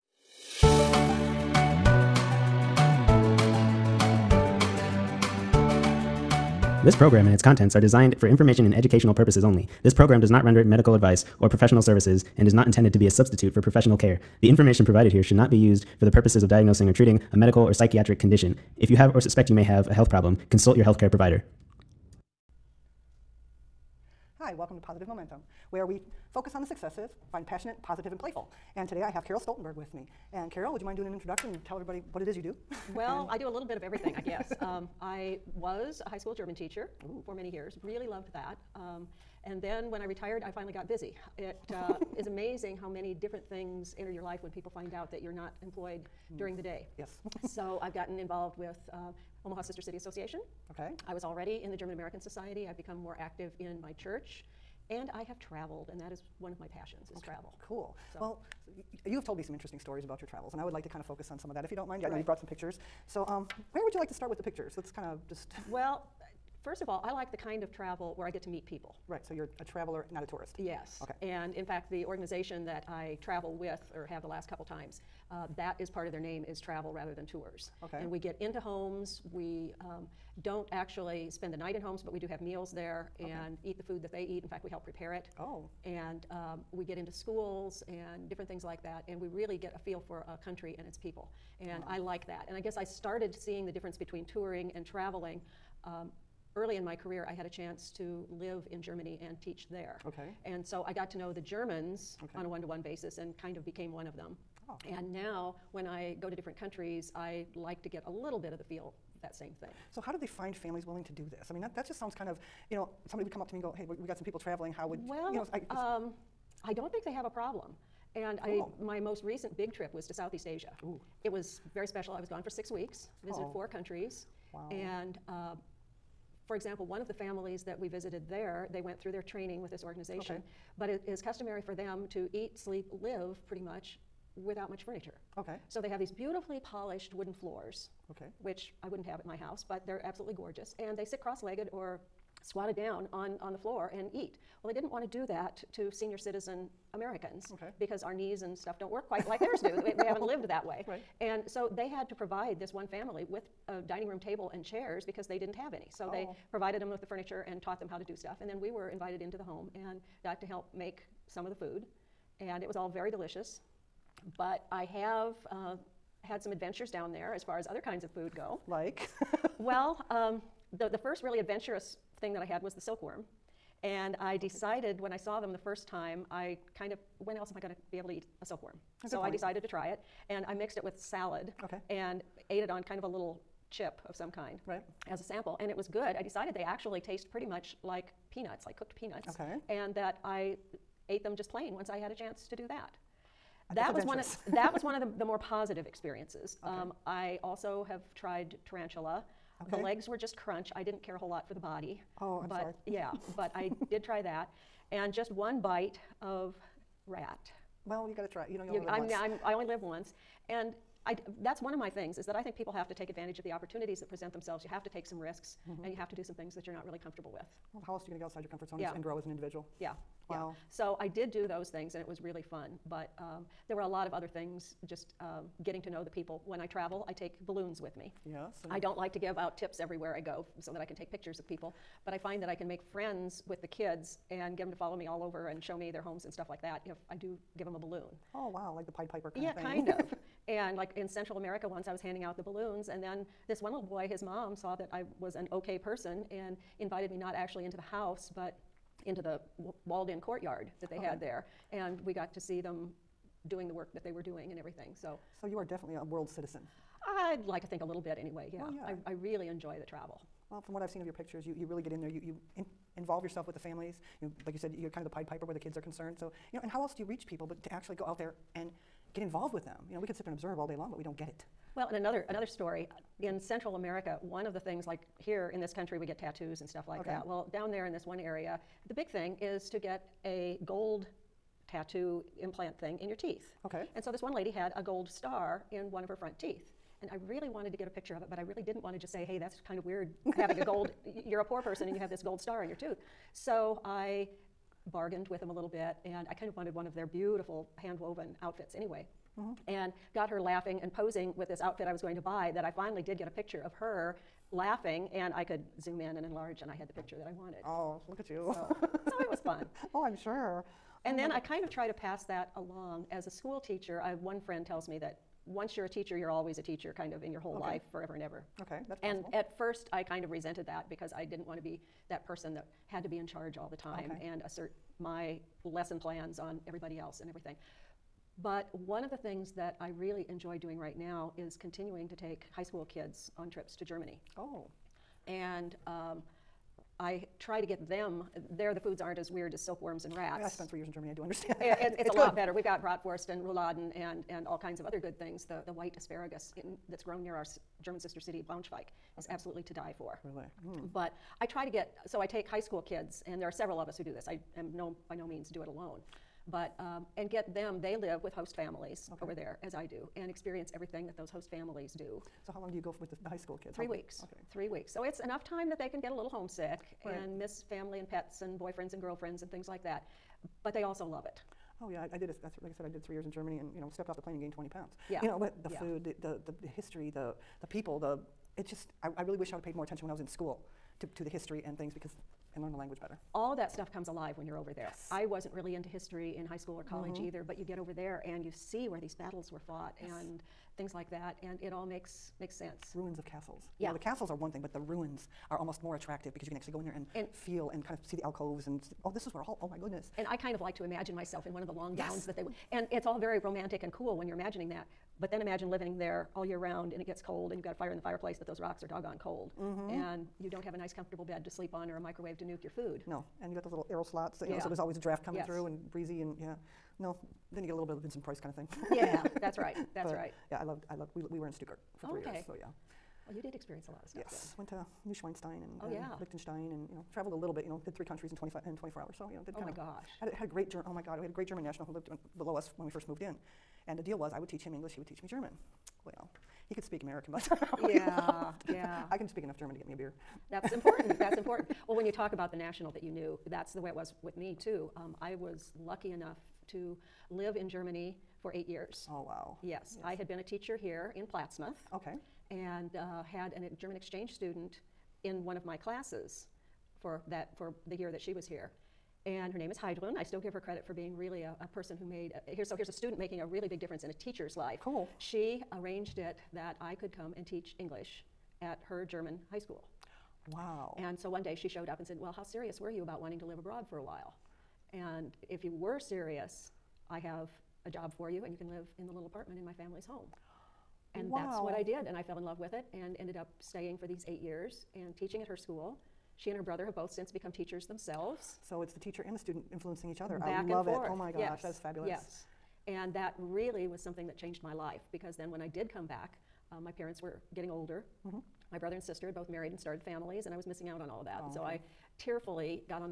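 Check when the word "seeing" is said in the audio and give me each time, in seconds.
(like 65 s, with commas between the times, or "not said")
93 s.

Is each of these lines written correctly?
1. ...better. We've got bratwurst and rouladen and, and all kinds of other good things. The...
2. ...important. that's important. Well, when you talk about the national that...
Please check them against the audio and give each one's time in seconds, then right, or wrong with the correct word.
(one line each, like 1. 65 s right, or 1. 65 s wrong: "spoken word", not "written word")
1. 342 s right
2. 440 s right.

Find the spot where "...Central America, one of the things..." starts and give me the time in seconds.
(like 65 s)
273 s.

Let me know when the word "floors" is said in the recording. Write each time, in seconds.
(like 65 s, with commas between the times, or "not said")
137 s, 143 s.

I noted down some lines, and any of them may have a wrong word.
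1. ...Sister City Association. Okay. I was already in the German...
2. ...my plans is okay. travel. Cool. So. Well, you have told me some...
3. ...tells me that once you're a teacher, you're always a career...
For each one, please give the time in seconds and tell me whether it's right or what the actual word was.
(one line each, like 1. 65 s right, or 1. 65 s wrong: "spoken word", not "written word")
1. 49 s right
2. 56 s wrong: "passions", not "plans"
3. 314 s wrong: "teacher", not "career".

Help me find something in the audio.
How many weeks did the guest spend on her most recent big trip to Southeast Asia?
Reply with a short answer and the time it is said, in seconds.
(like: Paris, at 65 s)
6, at 122 s.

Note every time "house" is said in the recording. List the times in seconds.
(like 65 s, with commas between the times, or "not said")
139 s, 247 s.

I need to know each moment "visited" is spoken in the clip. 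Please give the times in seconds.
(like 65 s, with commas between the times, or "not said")
123 s, 127 s.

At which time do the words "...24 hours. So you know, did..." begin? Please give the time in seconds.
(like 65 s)
428 s.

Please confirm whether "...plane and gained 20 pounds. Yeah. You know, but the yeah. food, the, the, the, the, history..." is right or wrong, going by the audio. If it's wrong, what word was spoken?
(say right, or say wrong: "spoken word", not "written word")
right.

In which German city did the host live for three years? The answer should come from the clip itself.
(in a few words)
Stuttgart.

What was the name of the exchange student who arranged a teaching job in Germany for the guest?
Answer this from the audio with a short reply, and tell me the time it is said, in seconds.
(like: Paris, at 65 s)
Heidrun, at 459 s.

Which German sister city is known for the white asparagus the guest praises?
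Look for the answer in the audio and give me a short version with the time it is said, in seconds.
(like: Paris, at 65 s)
Braunschweig, at 348 s.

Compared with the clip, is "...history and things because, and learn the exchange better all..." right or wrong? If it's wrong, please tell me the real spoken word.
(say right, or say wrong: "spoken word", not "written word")
wrong: "language", not "exchange".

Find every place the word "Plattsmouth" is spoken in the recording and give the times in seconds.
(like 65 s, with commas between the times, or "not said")
451 s.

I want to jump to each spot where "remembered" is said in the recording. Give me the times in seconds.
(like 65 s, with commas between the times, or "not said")
not said.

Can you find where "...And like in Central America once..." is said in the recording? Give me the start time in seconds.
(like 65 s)
240 s.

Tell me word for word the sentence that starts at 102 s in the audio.
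on a one to one basis and kind of became one of them.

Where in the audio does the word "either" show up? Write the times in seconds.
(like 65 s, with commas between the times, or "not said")
387 s.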